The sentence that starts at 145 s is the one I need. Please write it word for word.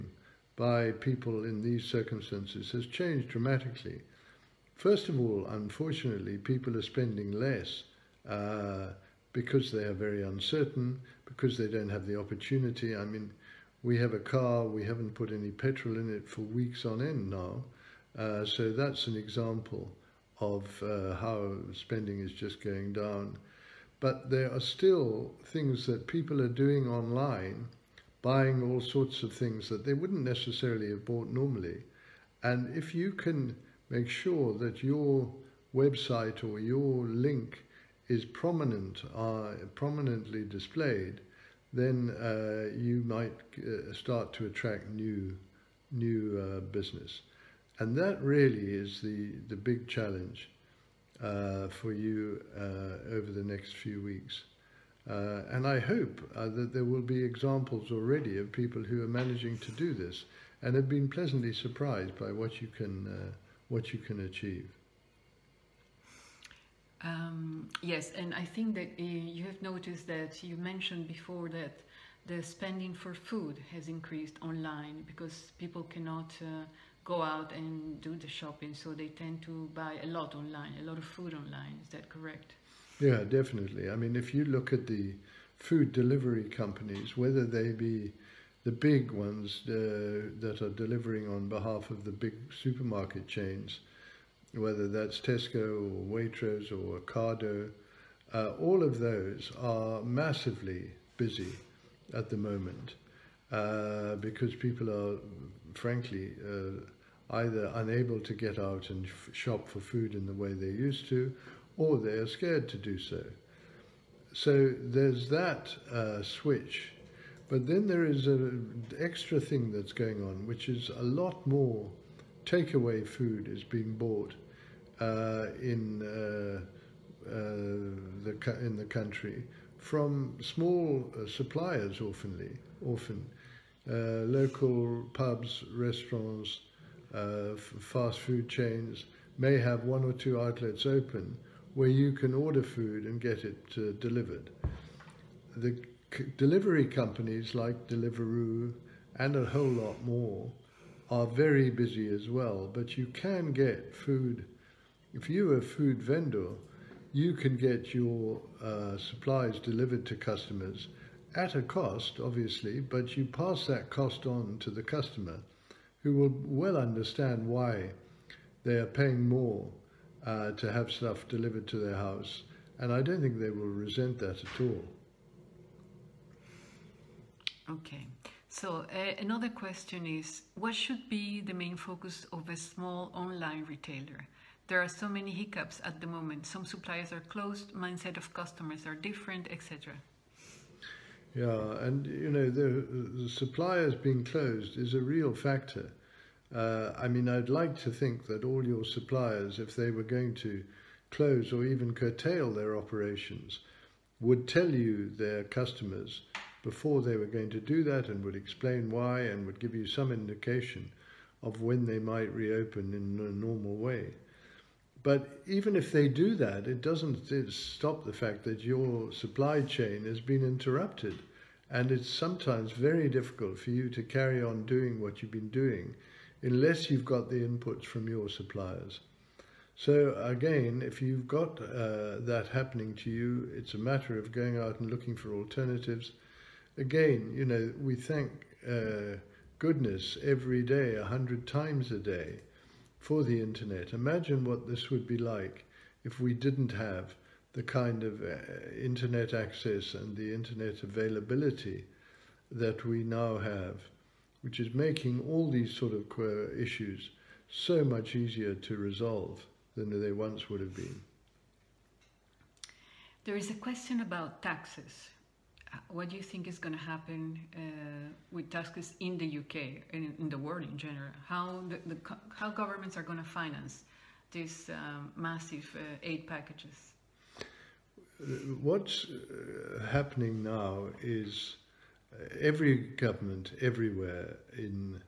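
The delivery companies like Deliveroo and a whole lot more are very busy as well, but you can get food.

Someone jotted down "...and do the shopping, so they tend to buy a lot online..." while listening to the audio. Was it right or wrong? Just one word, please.
right.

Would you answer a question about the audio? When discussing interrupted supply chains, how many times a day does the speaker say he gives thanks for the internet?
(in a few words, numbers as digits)
100.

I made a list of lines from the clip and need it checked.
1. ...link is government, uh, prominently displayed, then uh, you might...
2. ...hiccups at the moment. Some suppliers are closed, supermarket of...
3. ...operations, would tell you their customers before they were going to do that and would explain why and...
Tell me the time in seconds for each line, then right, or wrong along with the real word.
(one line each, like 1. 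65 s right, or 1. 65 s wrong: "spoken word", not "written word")
1. 37 s wrong: "prominent", not "government"
2. 185 s wrong: "mindset", not "supermarket"
3. 202 s right.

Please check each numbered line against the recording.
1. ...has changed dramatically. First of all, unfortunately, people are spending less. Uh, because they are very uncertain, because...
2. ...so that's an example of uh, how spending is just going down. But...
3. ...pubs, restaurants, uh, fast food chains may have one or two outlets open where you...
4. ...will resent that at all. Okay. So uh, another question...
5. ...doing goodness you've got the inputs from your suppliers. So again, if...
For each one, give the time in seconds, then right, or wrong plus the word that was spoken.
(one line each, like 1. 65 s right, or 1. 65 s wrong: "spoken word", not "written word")
1. 2 s right
2. 18 s right
3. 135 s right
4. 173 s right
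5. 225 s wrong: "unless", not "goodness".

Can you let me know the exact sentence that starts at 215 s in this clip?
But even if they do that, it doesn't stop the fact that your supply chain has been interrupted.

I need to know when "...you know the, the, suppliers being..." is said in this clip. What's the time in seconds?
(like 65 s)
192 s.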